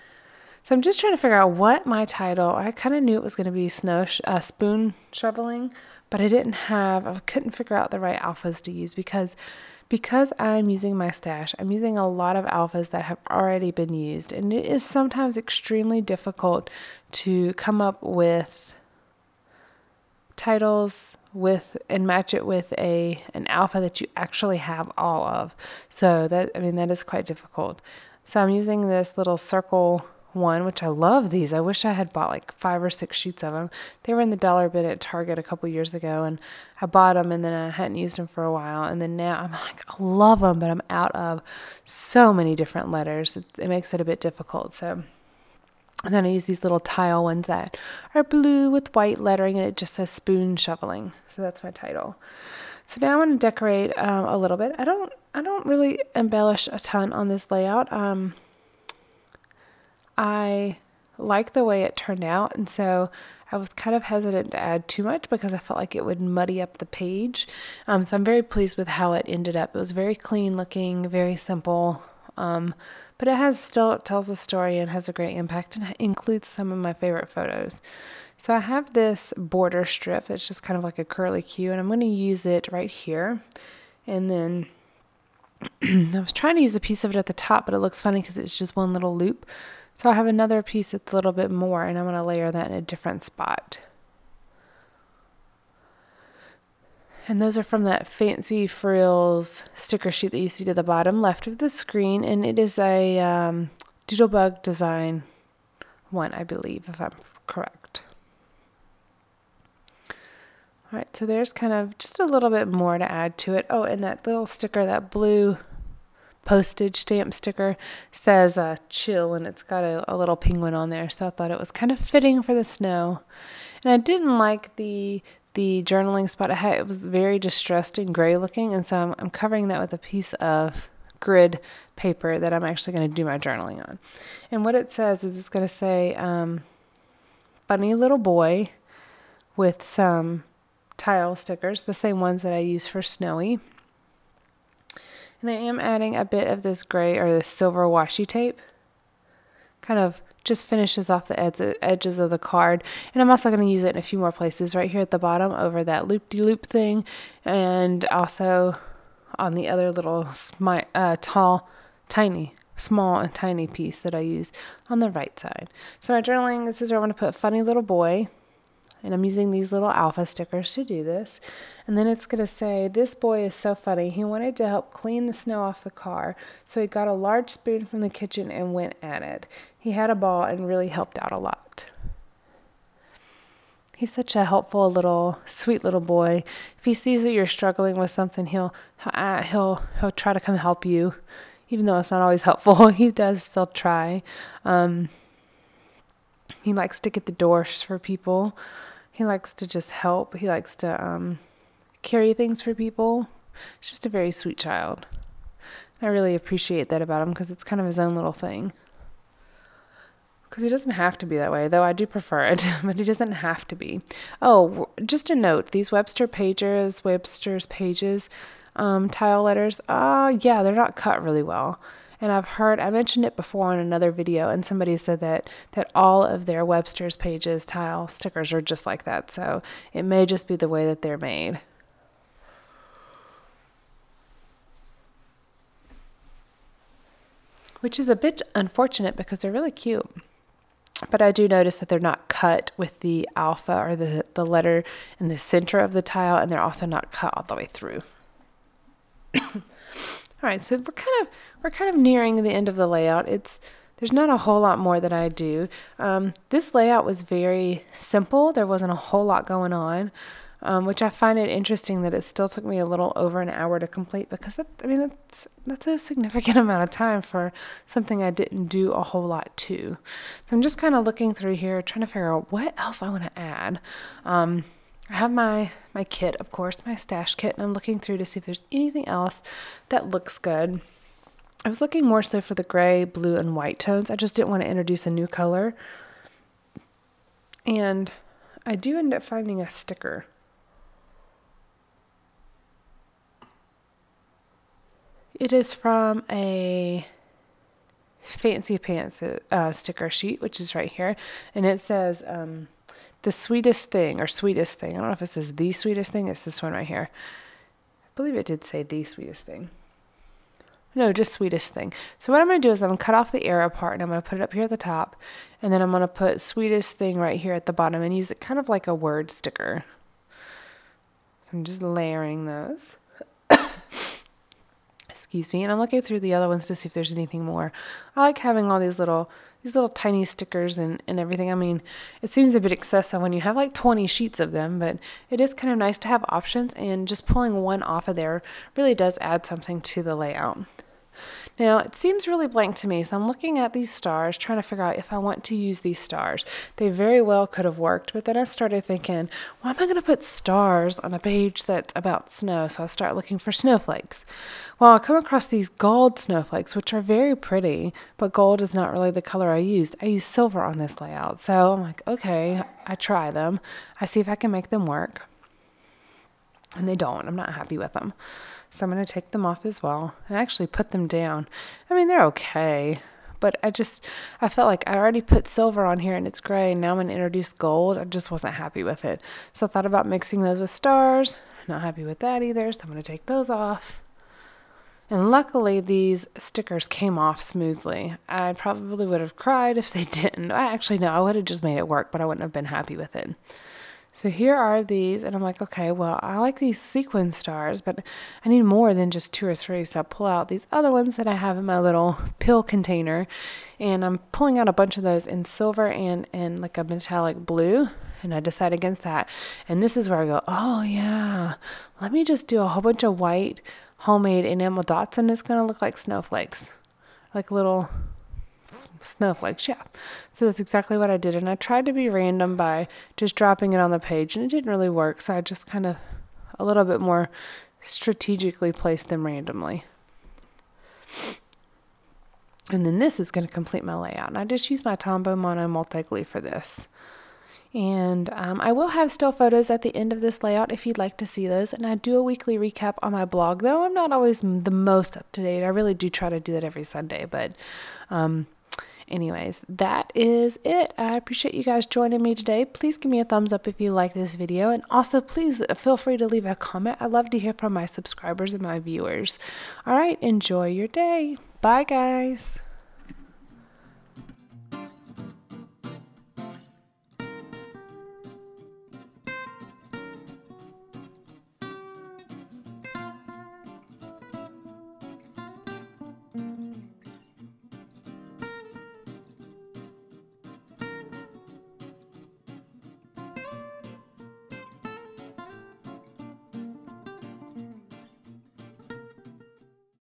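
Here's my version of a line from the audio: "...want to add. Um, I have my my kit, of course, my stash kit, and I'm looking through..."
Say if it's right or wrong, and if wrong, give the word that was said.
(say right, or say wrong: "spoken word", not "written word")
right.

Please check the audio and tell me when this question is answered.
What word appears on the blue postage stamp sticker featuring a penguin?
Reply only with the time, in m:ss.
1:58.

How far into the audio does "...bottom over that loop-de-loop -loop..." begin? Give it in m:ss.
2:35.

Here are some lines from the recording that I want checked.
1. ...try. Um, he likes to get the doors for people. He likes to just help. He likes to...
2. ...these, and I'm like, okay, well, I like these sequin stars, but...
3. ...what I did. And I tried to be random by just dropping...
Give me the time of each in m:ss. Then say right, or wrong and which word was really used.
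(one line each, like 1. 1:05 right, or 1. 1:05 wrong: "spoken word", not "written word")
1. 3:13 right
2. 6:34 right
3. 7:00 right.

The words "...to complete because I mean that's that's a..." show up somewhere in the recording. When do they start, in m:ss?
4:23.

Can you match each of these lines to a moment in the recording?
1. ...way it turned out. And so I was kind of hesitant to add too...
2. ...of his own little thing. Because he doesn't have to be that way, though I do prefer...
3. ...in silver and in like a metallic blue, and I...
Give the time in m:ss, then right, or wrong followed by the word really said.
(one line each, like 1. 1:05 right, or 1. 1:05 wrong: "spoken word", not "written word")
1. 1:01 right
2. 3:27 right
3. 6:45 right.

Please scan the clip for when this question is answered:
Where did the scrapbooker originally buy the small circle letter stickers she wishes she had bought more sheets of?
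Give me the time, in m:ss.
0:35.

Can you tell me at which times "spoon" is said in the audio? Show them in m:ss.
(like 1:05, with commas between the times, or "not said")
0:04, 0:50, 2:57.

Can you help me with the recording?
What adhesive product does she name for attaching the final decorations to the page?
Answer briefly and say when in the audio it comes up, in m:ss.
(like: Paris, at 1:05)
Tombow Mono Multi-Glue, at 7:14.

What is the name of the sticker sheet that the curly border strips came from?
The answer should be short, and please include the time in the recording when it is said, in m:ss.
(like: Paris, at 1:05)
Fancy Frills, at 1:38.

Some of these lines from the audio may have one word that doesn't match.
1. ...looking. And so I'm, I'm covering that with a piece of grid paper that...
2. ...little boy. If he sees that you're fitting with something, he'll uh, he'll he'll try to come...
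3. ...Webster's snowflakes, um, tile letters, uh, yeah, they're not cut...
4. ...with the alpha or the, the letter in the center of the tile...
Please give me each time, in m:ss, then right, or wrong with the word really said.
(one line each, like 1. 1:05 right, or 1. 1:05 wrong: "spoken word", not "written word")
1. 2:08 right
2. 3:05 wrong: "struggling", not "fitting"
3. 3:37 wrong: "pages", not "snowflakes"
4. 4:02 right.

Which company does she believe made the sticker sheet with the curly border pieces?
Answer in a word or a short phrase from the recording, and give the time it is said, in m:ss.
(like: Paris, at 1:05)
Doodlebug, at 1:44.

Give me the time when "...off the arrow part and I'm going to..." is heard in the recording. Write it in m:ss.
5:13.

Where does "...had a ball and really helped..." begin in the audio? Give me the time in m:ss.
2:59.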